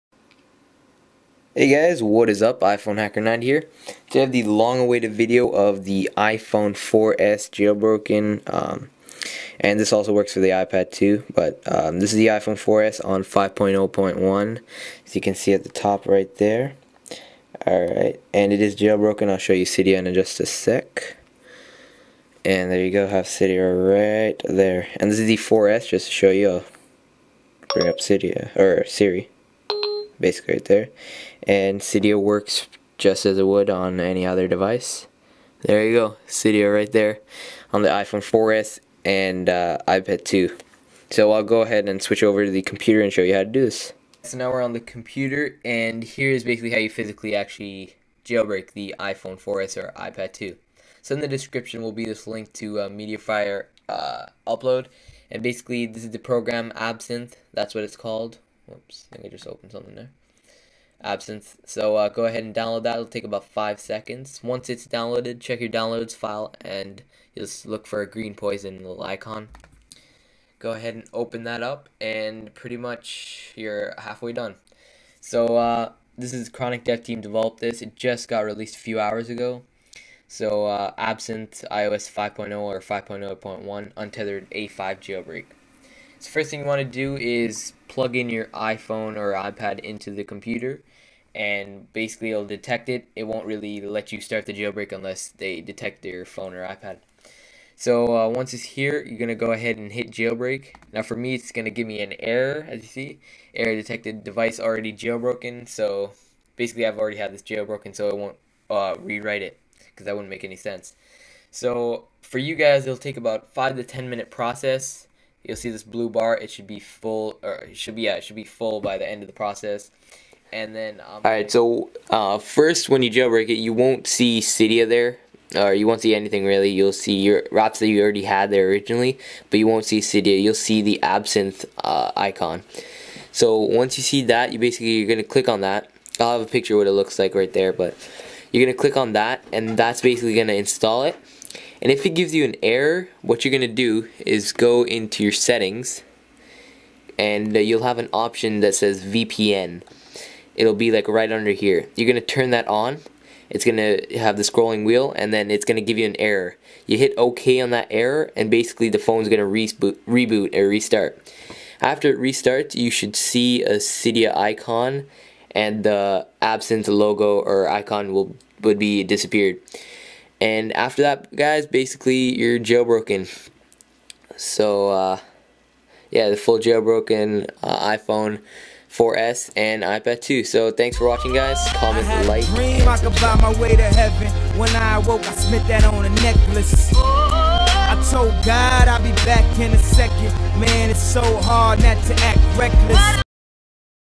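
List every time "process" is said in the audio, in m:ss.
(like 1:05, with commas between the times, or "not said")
1:54, 1:59.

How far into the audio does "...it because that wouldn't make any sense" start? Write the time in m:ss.
1:49.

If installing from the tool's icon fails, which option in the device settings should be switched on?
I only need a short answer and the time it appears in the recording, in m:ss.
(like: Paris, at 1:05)
VPN, at 2:29.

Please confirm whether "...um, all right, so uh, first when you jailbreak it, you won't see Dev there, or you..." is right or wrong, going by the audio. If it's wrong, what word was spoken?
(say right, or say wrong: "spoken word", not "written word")
wrong: "Cydia", not "Dev".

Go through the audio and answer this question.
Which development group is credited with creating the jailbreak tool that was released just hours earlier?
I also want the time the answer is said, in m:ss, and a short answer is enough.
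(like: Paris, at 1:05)
Chronic Dev Team, at 1:16.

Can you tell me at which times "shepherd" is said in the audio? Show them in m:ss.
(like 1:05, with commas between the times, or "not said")
not said.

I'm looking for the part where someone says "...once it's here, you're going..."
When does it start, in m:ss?
1:38.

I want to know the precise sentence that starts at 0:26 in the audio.
I'll bring up Cydia or Siri.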